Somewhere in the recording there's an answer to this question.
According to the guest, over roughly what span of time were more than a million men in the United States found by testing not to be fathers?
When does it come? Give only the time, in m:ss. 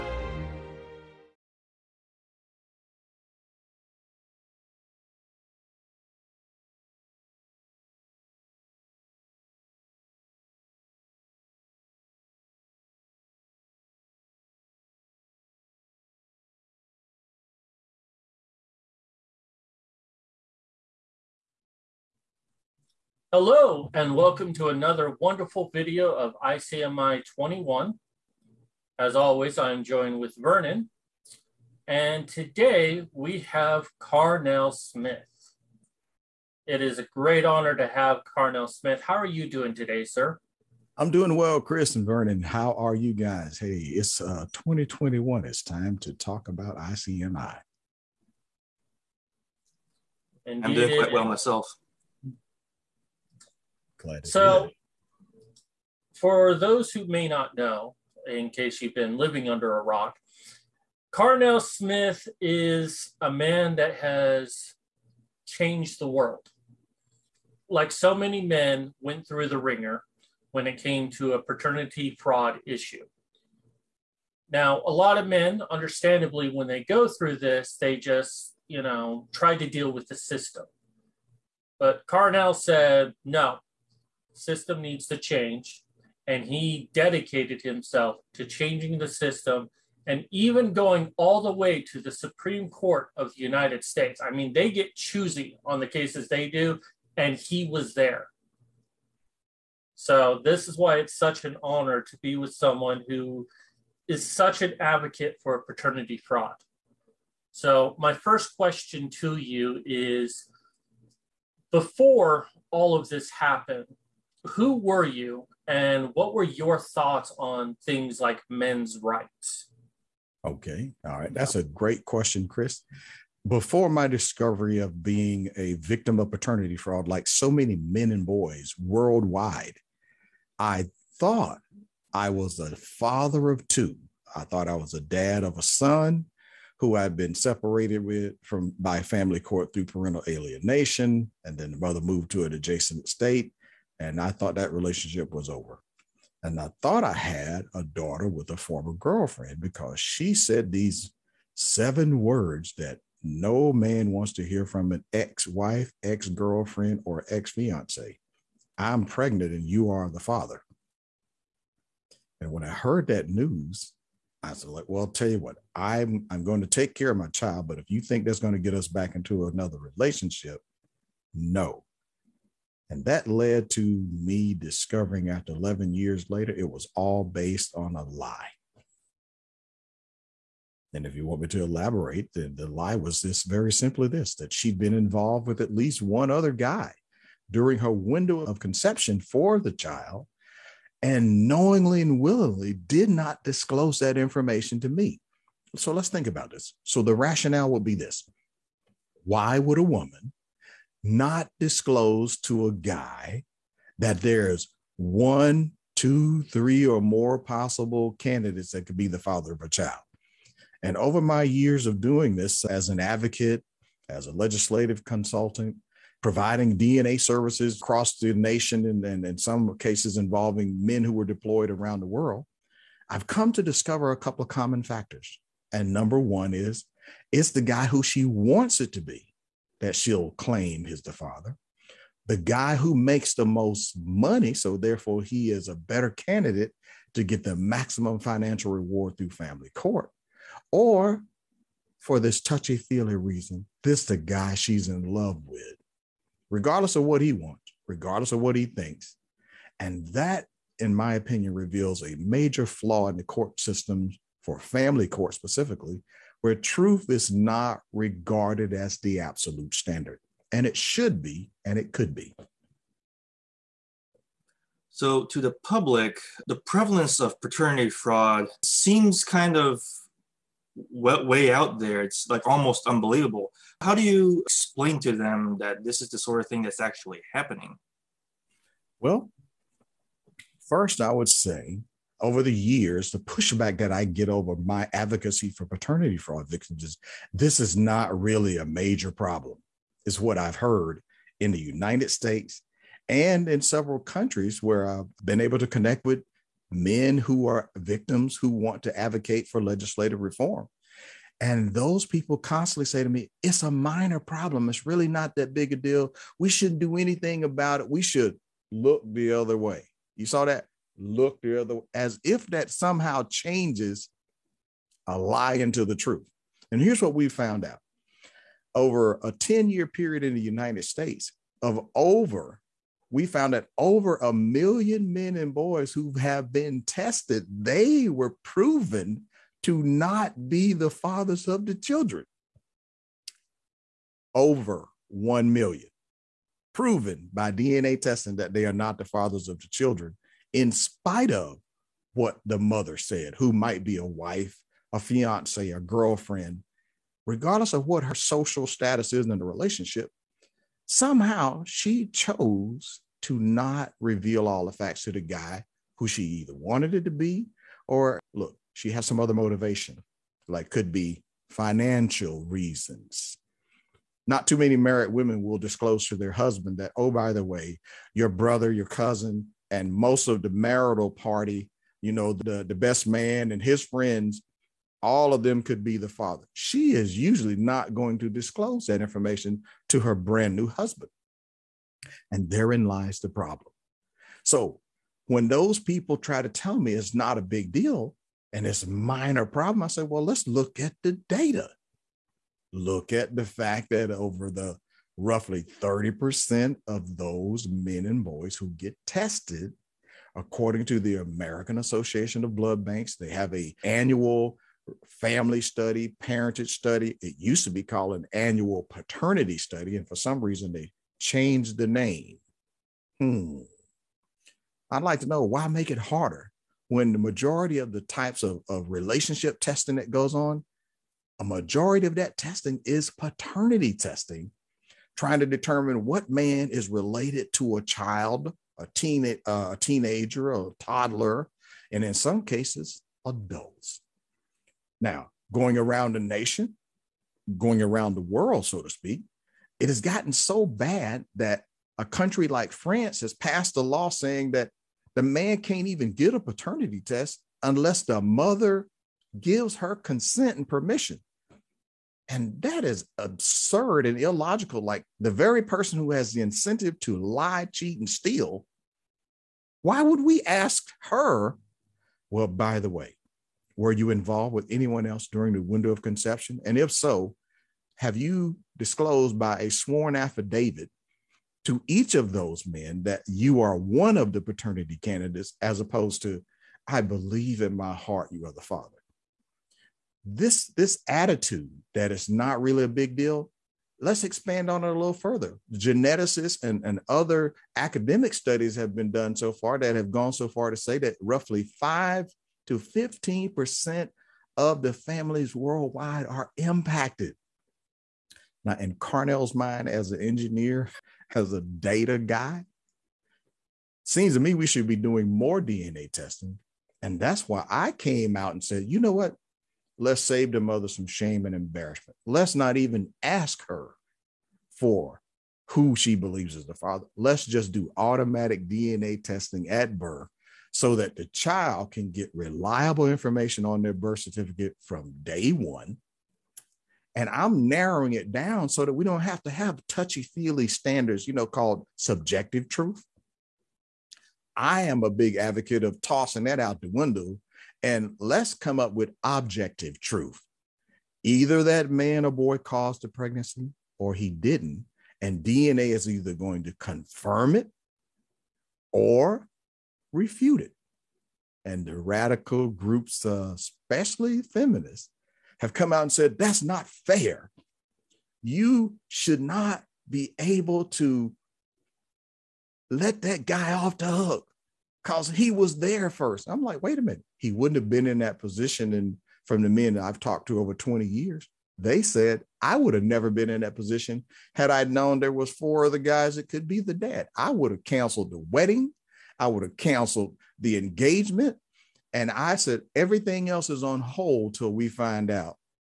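5:19.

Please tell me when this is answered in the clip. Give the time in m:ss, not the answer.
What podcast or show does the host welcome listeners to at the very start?
0:26.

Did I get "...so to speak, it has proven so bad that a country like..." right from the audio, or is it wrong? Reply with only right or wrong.
wrong.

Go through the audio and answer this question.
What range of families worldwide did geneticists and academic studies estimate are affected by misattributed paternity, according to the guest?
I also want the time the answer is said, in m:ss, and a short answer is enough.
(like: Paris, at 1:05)
5 to 15 percent, at 8:11.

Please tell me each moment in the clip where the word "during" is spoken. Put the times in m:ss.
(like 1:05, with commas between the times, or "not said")
3:07, 7:45.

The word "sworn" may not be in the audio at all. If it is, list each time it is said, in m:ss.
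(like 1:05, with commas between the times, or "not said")
7:49.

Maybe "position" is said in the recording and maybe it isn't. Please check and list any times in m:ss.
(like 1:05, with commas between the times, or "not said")
9:28, 9:33.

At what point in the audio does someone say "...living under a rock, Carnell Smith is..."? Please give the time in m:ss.
0:59.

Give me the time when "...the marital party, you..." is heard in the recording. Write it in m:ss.
6:10.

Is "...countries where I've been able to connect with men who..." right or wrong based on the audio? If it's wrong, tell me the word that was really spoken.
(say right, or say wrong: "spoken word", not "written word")
right.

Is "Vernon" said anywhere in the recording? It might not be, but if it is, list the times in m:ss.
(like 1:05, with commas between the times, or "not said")
0:30, 0:42.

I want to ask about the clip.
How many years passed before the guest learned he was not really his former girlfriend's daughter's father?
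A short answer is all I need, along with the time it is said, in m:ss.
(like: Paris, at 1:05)
11, at 2:55.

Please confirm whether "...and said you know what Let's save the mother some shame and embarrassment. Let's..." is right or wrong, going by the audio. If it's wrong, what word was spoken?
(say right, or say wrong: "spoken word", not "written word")
right.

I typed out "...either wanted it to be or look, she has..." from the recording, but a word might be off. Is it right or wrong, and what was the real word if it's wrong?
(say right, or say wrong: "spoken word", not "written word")
right.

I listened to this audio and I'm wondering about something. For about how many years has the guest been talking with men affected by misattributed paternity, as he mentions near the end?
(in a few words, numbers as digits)
20.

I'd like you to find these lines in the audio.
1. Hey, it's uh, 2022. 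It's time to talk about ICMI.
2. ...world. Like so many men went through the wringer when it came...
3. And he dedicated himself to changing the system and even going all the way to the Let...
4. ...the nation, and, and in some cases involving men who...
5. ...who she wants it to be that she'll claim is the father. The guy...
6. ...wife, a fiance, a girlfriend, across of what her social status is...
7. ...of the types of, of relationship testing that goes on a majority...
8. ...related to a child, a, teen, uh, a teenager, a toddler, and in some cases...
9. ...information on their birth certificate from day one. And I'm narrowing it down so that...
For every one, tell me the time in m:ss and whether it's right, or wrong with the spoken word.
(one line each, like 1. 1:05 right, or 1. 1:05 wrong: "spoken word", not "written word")
1. 0:43 wrong: "2021", not "2022"
2. 1:06 right
3. 1:26 wrong: "Supreme", not "Let"
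4. 3:38 right
5. 3:47 right
6. 5:44 wrong: "regardless", not "across"
7. 6:57 right
8. 7:06 right
9. 8:43 right.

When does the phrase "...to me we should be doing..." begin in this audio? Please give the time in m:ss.
8:24.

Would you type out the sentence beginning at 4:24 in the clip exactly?
So, to the public, the prevalence of paternity fraud seems kind of way out there.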